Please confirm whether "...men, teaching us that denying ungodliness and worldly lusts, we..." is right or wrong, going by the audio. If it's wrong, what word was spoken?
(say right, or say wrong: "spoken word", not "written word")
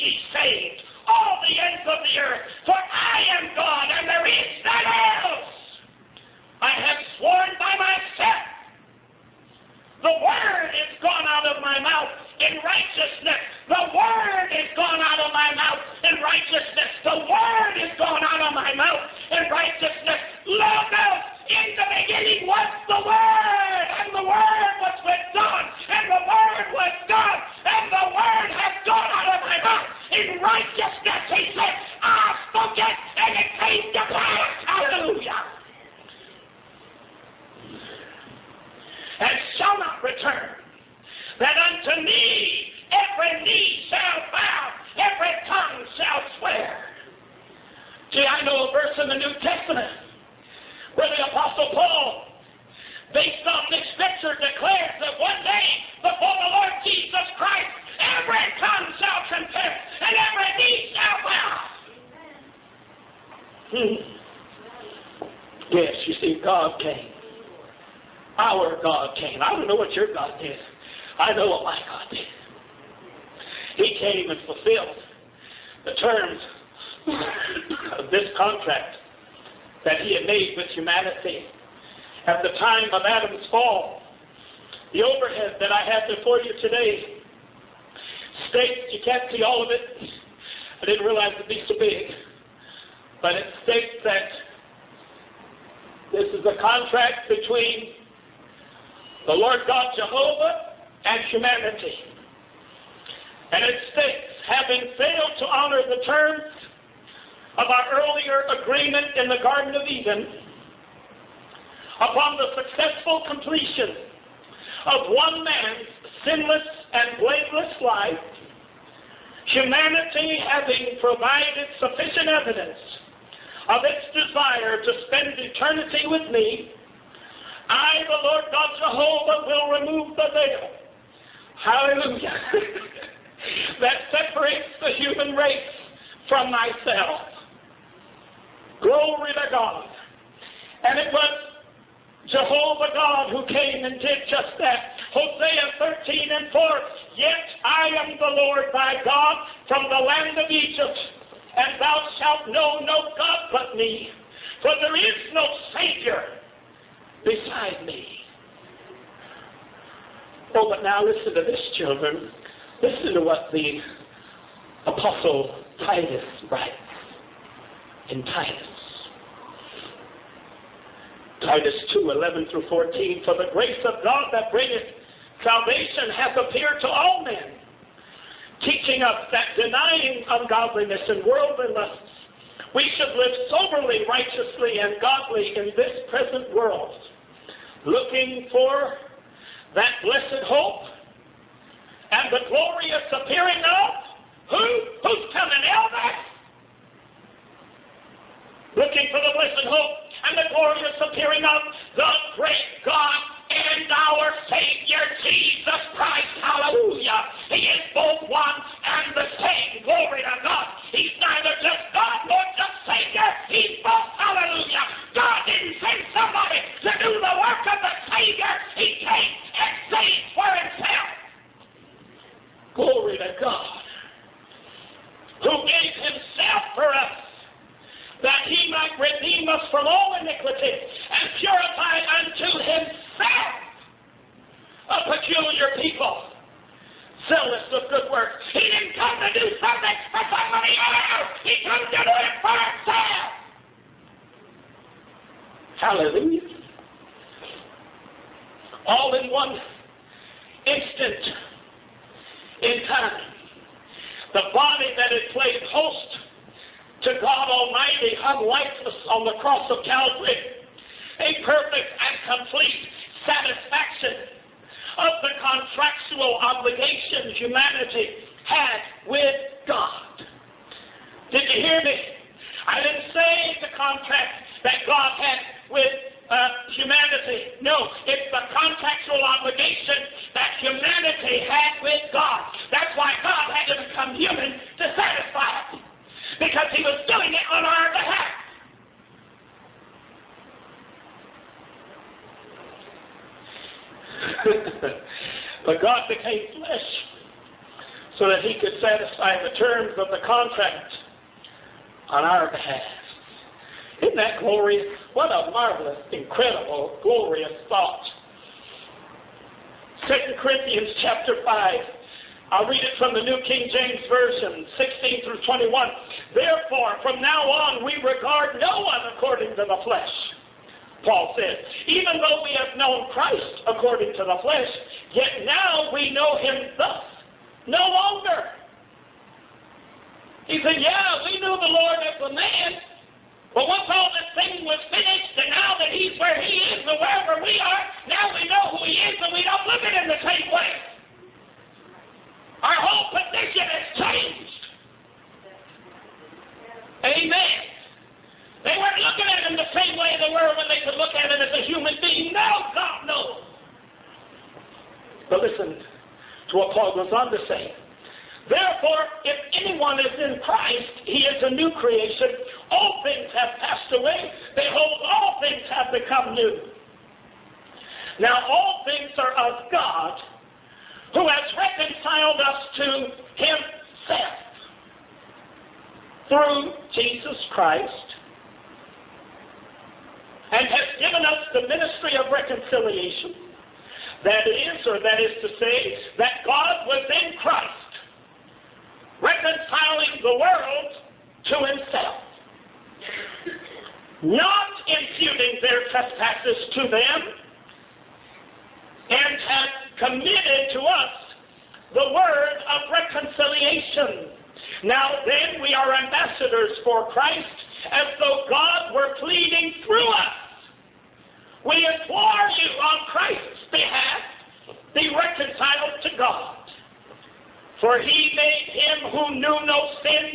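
right.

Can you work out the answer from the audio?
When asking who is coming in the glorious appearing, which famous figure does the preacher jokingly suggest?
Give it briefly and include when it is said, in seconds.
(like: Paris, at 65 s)
Elvis, at 195 s.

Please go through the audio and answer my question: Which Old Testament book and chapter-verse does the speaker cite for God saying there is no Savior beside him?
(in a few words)
Hosea 13:4.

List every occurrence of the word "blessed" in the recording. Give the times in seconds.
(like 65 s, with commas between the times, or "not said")
190 s, 199 s.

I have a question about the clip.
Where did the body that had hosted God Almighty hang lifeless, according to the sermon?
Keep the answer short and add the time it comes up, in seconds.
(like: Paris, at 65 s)
Calvary, at 259 s.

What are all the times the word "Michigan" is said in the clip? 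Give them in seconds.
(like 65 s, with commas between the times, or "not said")
not said.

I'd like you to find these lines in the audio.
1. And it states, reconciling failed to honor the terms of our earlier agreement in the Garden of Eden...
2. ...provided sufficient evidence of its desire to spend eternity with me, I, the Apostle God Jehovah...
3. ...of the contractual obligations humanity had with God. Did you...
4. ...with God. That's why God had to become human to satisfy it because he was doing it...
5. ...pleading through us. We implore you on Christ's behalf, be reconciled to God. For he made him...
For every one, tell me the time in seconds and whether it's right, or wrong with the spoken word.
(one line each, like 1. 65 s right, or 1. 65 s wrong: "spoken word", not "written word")
1. 103 s wrong: "having", not "reconciling"
2. 121 s wrong: "Lord", not "Apostle"
3. 264 s right
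4. 281 s right
5. 409 s right.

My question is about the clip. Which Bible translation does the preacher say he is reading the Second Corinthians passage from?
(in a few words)
New King James Version.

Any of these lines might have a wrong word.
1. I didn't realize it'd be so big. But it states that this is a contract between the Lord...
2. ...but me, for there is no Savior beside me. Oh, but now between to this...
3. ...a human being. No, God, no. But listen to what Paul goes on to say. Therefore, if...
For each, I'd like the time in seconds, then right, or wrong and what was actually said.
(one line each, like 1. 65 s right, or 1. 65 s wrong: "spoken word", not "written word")
1. 90 s right
2. 153 s wrong: "listen", not "between"
3. 351 s right.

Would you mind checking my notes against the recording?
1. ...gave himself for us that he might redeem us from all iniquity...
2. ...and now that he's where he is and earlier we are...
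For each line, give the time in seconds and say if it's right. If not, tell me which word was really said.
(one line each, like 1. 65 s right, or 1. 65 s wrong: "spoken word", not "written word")
1. 225 s right
2. 335 s wrong: "wherever", not "earlier".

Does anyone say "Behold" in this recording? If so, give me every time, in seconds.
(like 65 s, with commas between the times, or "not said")
364 s.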